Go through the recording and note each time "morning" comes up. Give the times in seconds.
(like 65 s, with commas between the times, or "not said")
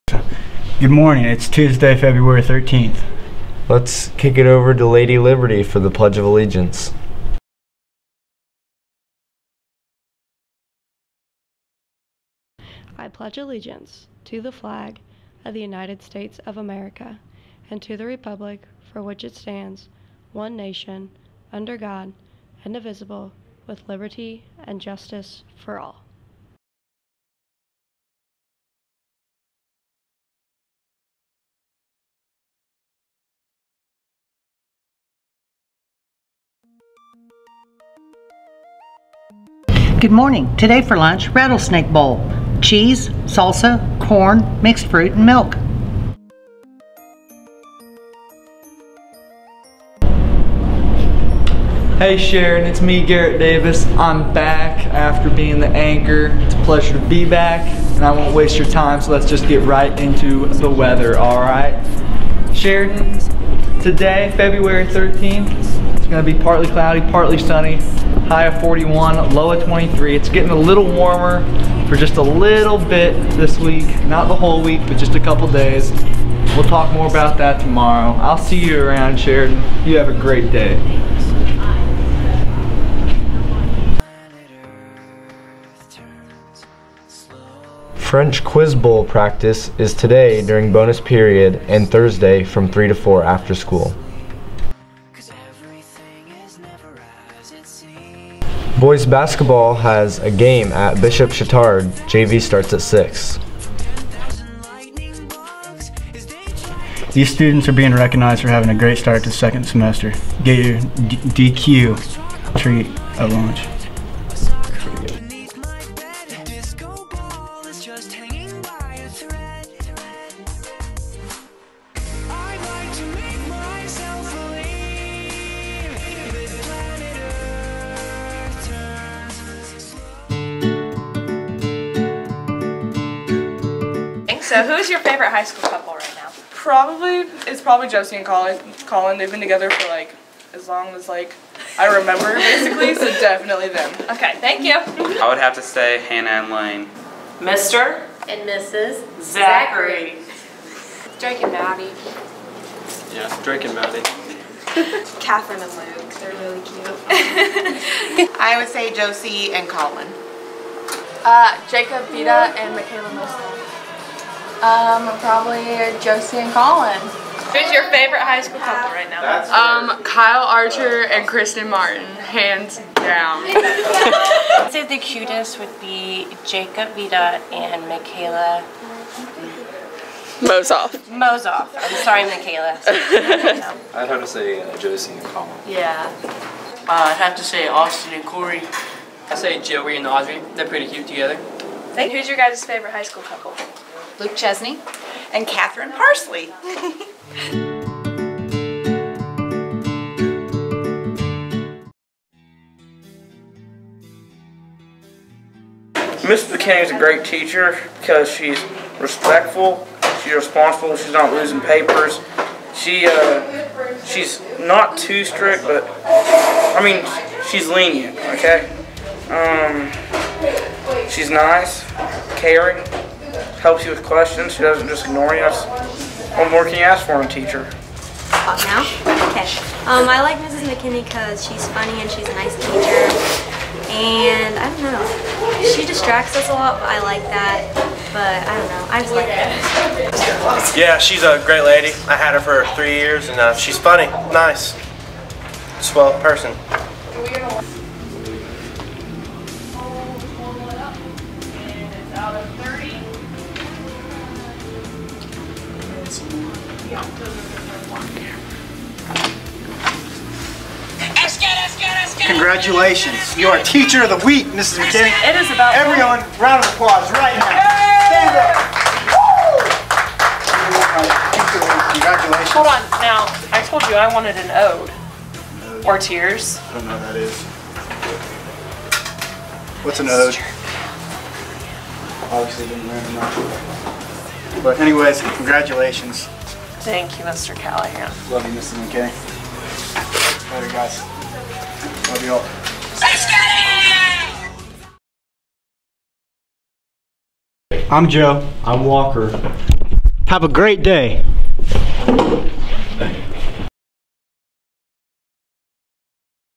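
0 s, 40 s.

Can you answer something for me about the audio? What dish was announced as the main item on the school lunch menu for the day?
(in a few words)
Rattlesnake bowl.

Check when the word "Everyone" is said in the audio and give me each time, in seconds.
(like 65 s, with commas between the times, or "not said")
265 s.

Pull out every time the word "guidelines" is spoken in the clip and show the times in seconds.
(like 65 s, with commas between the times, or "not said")
not said.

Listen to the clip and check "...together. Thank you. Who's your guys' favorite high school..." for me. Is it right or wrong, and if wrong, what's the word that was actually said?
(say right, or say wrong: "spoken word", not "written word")
right.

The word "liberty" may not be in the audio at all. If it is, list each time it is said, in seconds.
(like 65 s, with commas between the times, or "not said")
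5 s, 23 s.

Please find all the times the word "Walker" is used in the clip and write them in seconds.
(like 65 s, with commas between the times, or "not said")
298 s.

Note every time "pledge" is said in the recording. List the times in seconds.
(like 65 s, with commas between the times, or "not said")
5 s, 13 s.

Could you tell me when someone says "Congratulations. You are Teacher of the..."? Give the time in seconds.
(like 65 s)
262 s.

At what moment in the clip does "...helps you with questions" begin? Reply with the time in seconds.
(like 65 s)
223 s.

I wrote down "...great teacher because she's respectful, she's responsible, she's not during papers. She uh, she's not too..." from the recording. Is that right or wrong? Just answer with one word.
wrong.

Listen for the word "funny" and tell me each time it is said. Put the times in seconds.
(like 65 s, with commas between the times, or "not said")
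231 s, 243 s.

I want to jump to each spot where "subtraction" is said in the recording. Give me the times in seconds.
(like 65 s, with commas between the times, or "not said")
not said.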